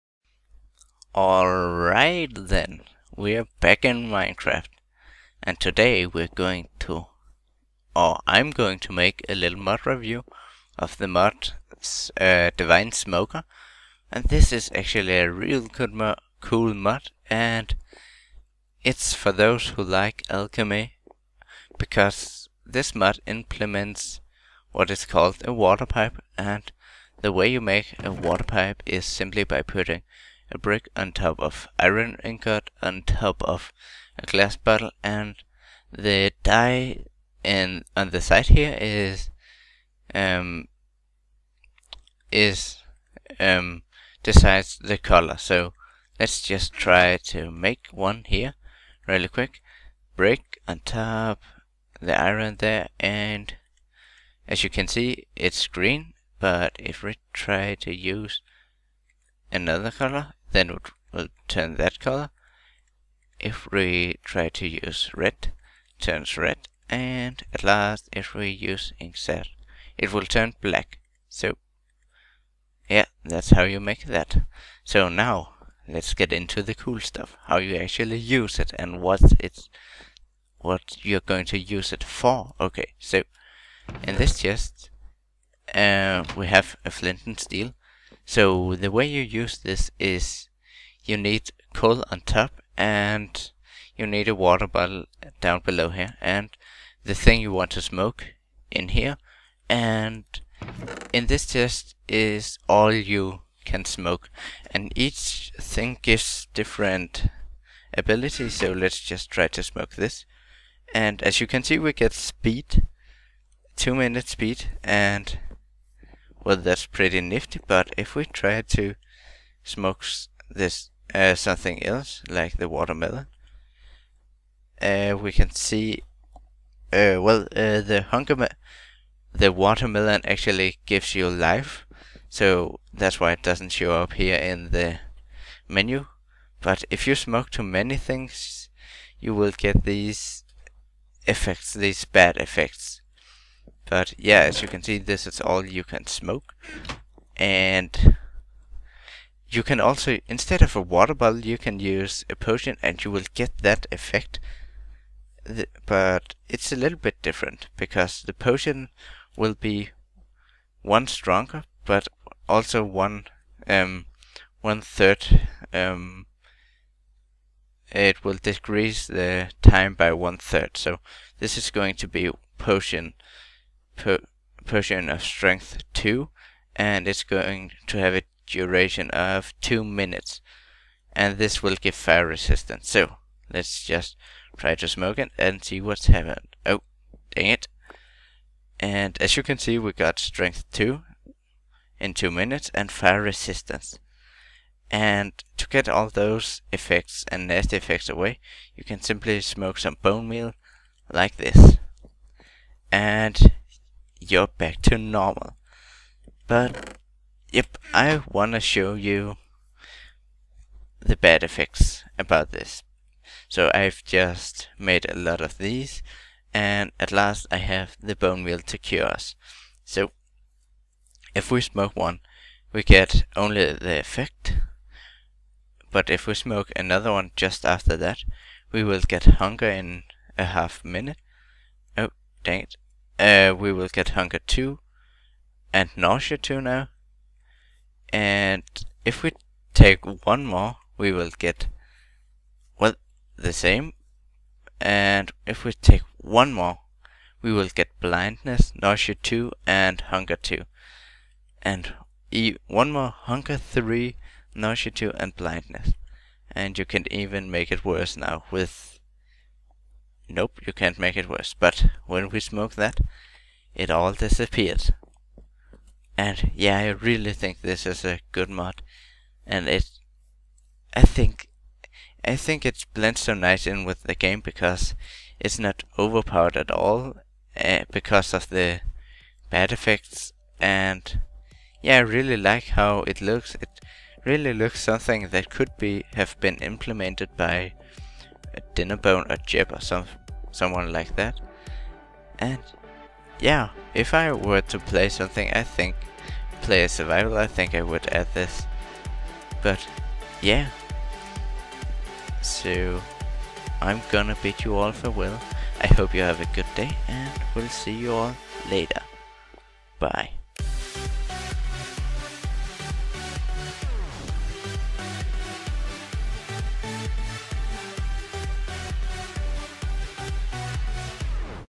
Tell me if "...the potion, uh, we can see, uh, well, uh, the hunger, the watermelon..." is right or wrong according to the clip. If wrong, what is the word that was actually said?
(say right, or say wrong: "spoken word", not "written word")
wrong: "watermelon", not "potion".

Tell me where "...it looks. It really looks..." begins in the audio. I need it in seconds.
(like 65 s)
283 s.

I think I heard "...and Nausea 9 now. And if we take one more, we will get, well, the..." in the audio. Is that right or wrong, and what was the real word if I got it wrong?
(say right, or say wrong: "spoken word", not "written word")
wrong: "2", not "9".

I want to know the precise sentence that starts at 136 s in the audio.
But if you smoke too many things, you will get these effects, these bad effects.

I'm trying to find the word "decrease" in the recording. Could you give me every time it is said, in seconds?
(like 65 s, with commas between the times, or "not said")
168 s.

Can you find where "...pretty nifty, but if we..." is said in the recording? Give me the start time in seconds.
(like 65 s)
116 s.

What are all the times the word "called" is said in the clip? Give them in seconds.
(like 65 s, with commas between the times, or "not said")
25 s.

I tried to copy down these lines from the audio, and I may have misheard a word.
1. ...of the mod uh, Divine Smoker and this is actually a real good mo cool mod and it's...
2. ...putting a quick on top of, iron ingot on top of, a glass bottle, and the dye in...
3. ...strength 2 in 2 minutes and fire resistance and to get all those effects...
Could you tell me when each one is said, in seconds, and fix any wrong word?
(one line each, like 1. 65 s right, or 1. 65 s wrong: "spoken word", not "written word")
1. 10 s right
2. 29 s wrong: "brick", not "quick"
3. 190 s right.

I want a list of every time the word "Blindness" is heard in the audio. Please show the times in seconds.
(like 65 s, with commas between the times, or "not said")
247 s, 255 s.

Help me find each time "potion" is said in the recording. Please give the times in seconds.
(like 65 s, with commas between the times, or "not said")
152 s, 158 s, 172 s.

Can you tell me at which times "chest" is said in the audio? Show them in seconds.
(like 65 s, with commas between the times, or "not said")
84 s, 101 s.